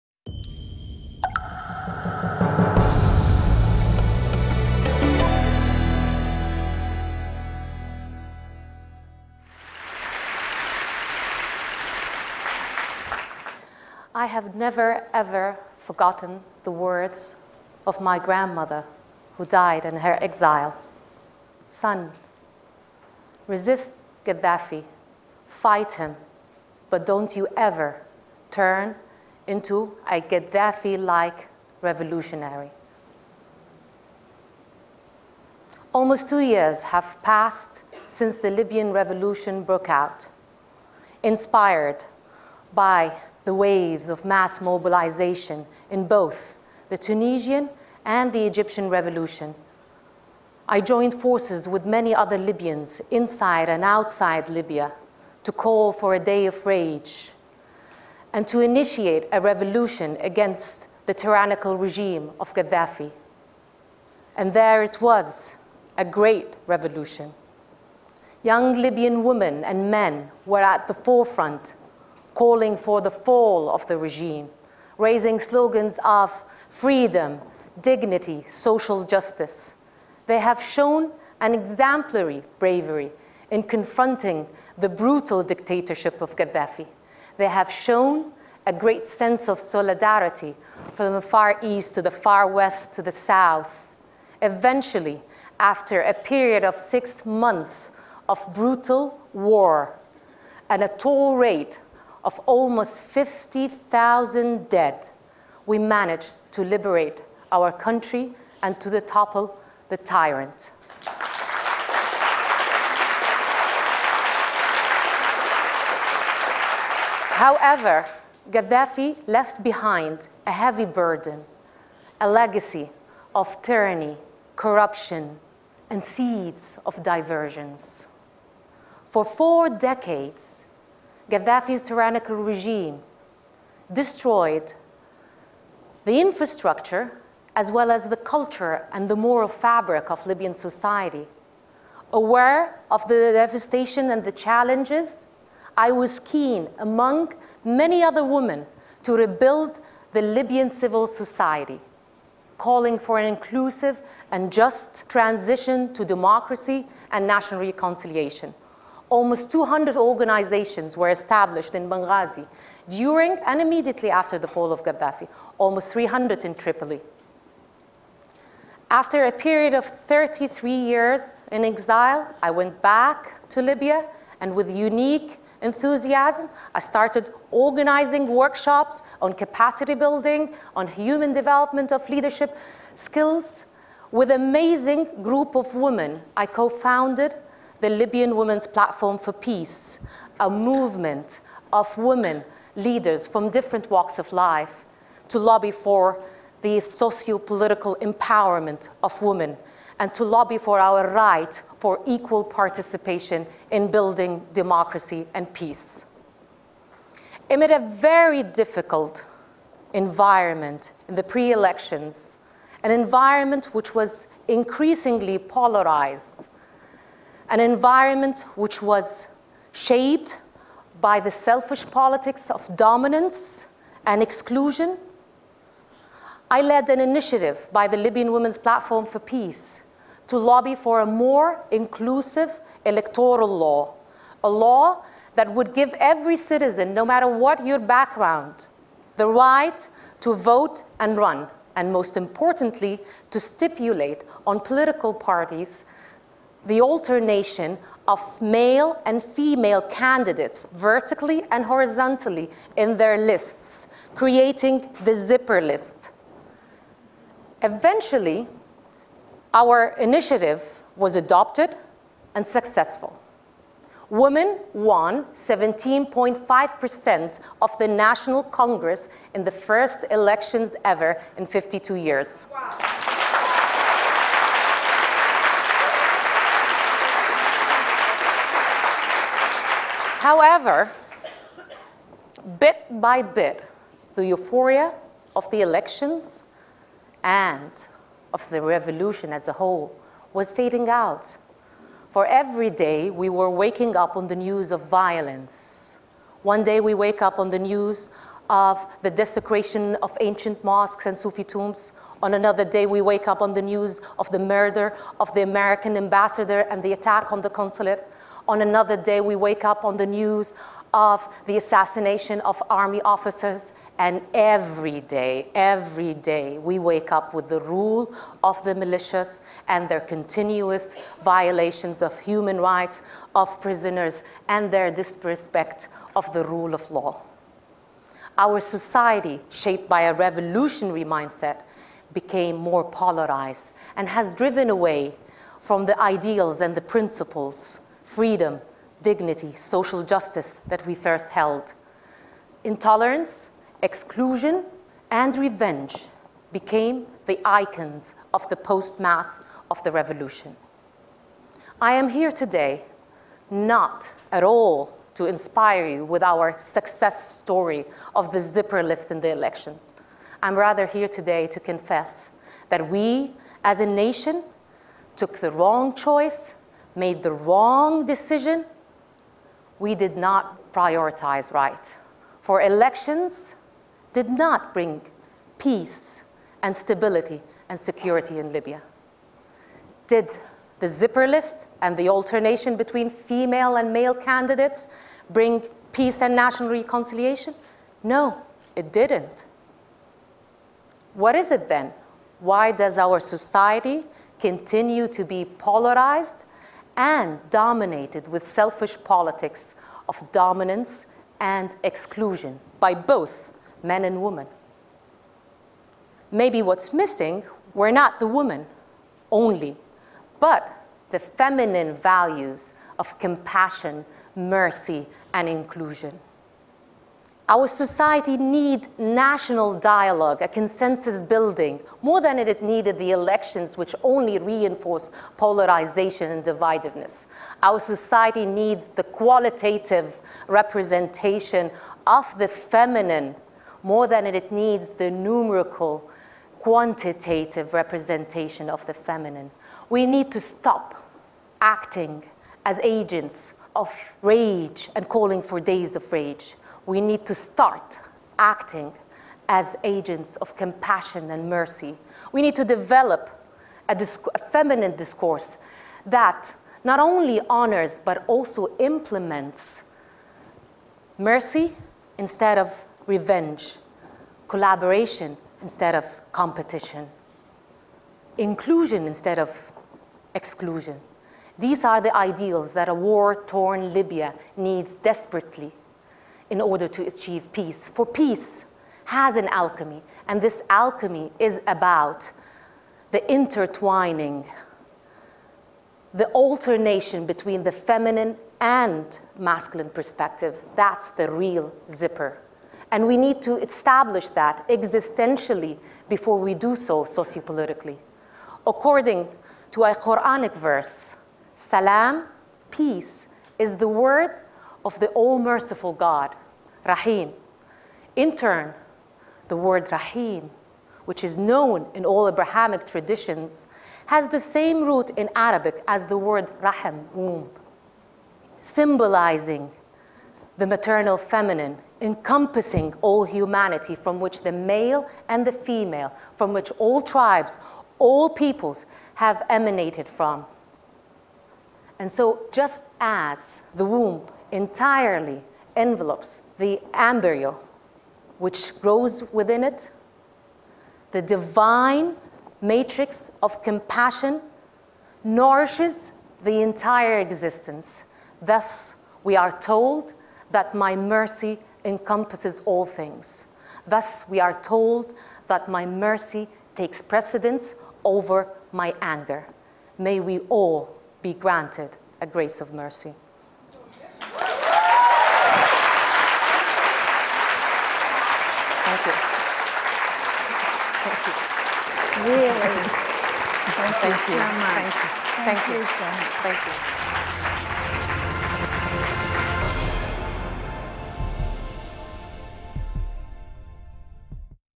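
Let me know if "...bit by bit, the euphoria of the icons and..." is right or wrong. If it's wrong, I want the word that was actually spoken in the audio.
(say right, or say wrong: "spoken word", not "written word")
wrong: "elections", not "icons".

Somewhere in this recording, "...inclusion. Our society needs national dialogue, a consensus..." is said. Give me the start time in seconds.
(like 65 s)
415 s.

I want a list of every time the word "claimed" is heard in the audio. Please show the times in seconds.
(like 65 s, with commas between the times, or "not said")
not said.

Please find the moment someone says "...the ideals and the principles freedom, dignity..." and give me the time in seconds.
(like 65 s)
335 s.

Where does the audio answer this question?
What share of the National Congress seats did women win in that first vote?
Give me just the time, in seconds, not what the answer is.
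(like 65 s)
265 s.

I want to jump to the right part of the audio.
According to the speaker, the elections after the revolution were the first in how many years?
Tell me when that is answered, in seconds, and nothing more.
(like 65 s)
271 s.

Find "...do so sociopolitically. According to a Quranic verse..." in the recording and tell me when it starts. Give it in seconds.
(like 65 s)
496 s.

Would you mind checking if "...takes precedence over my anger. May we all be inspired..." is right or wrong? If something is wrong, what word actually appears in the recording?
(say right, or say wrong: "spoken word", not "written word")
wrong: "granted", not "inspired".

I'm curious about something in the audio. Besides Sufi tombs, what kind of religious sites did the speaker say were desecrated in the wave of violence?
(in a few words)
ancient mosques.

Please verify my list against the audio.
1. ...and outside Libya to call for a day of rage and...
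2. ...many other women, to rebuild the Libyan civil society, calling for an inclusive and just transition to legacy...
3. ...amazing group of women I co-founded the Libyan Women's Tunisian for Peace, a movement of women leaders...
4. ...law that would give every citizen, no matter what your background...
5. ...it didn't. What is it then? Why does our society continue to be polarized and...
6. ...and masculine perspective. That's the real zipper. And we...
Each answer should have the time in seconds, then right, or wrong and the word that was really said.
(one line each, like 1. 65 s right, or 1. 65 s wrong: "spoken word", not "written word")
1. 53 s right
2. 147 s wrong: "democracy", not "legacy"
3. 184 s wrong: "Platform", not "Tunisian"
4. 234 s right
5. 388 s right
6. 488 s right.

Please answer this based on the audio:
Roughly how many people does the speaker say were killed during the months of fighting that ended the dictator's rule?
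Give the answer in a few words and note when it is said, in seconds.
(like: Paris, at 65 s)
50,000, at 102 s.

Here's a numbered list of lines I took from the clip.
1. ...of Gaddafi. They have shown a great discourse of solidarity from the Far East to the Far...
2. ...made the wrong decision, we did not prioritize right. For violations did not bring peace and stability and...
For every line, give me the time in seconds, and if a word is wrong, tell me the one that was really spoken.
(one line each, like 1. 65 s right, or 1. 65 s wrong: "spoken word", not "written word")
1. 86 s wrong: "sense", not "discourse"
2. 366 s wrong: "elections", not "violations".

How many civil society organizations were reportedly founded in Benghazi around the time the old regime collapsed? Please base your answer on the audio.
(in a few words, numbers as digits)
200.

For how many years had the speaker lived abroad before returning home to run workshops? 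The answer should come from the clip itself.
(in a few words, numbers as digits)
33 years.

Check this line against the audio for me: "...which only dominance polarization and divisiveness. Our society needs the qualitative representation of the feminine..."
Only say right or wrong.
wrong.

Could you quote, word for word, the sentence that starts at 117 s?
However, Gaddafi left behind a heavy burden, a legacy of tyranny, corruption, and seeds of diversions.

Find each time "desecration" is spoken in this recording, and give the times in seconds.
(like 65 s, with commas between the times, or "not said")
299 s.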